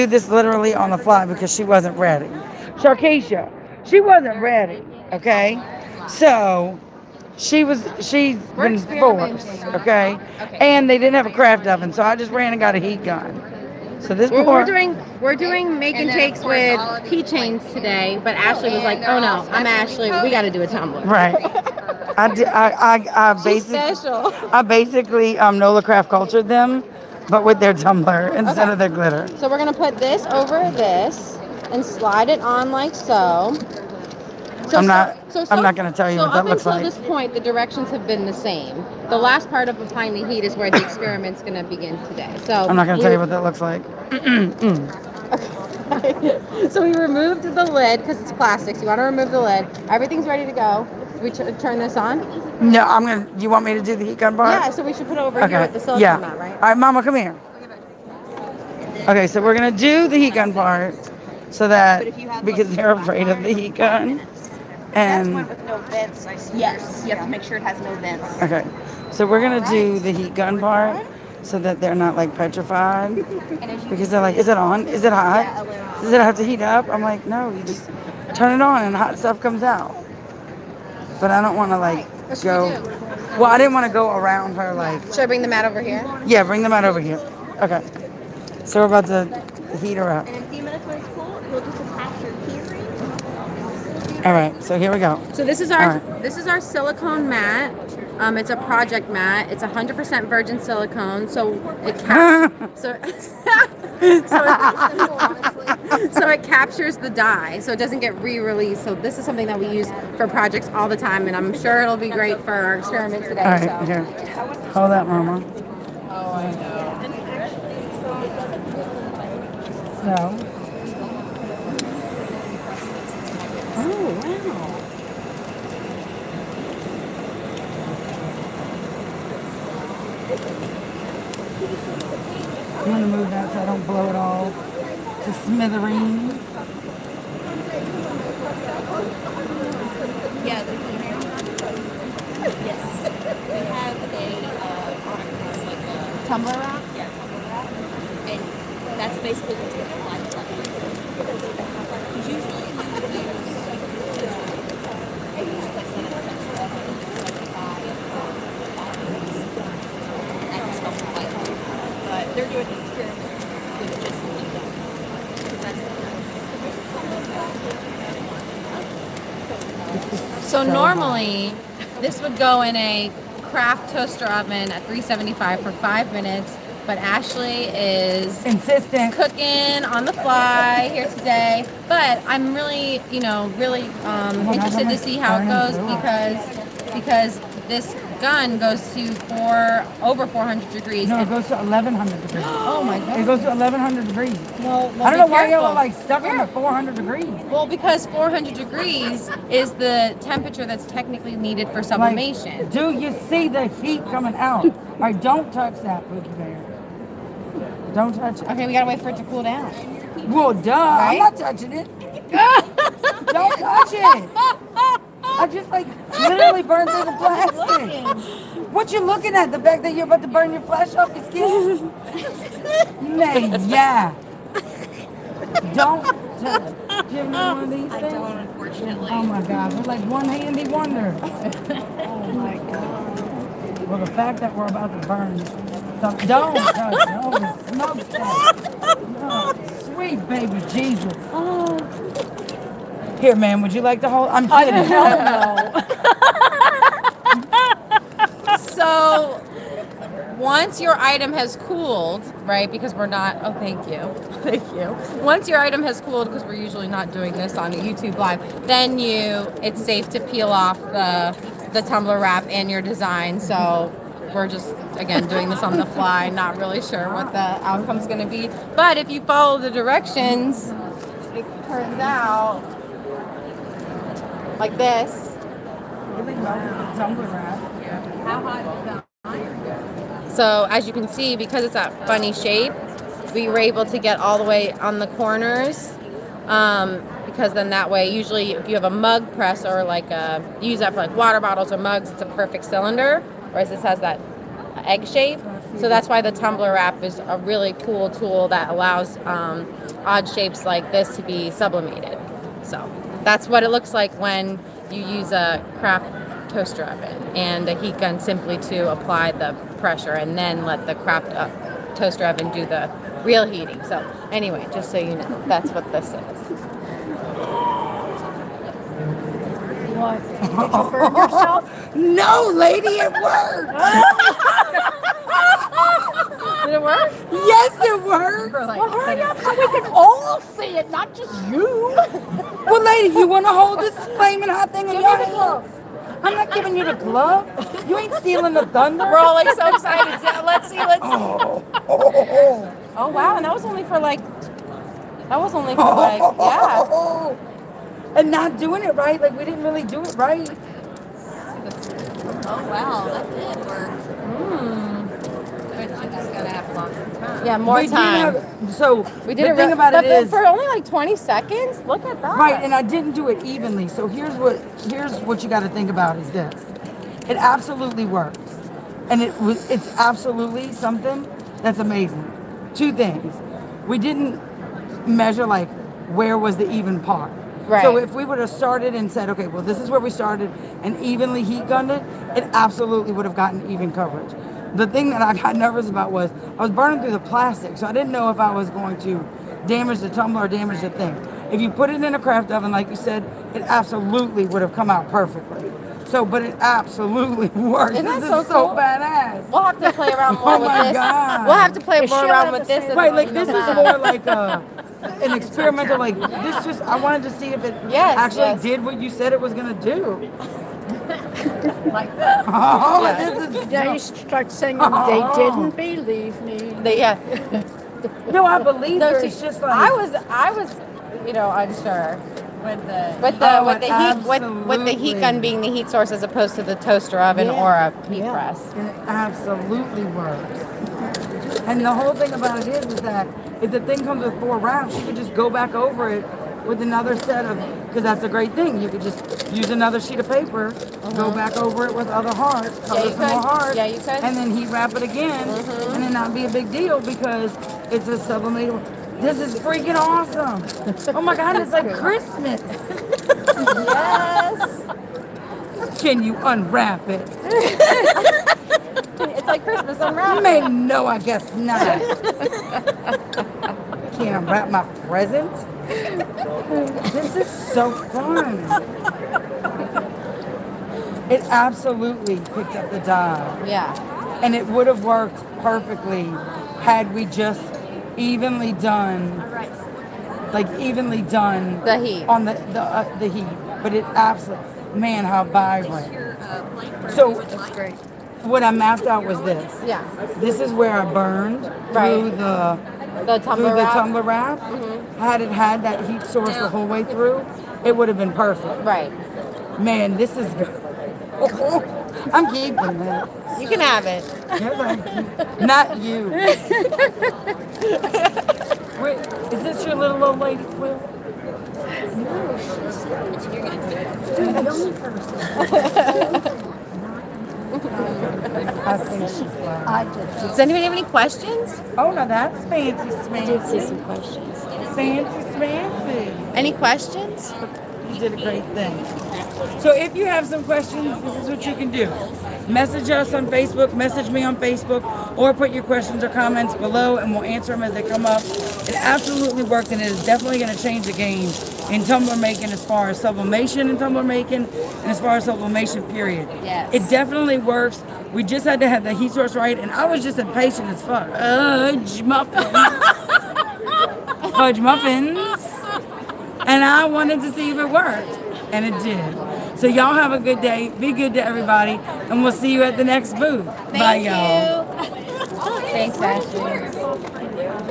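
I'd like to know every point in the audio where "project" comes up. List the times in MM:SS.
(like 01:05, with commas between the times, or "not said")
01:38, 01:50.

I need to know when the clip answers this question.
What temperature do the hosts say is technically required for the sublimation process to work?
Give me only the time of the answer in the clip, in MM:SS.
03:18.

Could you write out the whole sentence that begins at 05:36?
I'm not giving you the glove.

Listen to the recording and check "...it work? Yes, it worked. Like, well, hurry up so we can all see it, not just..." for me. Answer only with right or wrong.
right.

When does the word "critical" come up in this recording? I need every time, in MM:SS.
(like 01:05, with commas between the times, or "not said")
not said.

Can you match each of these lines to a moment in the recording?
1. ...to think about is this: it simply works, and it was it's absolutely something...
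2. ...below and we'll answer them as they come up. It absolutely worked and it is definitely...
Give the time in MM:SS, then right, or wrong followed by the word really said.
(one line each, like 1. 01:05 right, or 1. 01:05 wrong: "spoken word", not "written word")
1. 06:05 wrong: "absolutely", not "simply"
2. 08:56 right.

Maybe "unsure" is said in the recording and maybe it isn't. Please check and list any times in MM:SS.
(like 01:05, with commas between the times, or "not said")
07:01.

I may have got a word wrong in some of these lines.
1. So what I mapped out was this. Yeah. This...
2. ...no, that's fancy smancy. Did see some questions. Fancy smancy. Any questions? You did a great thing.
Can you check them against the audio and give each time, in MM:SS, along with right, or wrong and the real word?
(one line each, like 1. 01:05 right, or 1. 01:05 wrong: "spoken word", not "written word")
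1. 08:07 right
2. 08:42 right.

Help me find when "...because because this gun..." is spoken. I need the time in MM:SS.
03:05.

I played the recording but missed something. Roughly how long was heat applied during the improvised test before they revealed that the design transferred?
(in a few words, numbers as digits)
20 seconds.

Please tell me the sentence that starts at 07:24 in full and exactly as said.
and then heat wrap it again, uh-huh.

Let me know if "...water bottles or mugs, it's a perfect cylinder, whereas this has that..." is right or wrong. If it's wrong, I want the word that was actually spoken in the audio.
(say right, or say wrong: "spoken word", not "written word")
right.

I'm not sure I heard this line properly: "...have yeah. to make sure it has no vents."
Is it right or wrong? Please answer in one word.
right.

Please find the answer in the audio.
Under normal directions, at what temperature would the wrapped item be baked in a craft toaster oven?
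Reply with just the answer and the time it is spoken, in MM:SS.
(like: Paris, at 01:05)
375, at 02:54.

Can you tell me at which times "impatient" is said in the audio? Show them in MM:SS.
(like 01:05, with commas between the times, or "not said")
09:10.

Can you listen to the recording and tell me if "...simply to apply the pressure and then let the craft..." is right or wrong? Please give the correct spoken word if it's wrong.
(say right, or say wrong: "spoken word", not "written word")
right.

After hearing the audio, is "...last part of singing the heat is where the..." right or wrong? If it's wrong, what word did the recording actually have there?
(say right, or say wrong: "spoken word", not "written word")
wrong: "applying", not "singing".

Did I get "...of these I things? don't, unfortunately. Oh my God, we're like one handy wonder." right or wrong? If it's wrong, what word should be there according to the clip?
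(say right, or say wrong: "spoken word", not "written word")
right.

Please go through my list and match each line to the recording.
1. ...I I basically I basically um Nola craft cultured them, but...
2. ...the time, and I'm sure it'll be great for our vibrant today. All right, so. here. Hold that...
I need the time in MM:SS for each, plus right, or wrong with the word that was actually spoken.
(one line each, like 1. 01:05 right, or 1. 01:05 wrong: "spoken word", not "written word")
1. 00:22 right
2. 01:50 wrong: "experiment", not "vibrant".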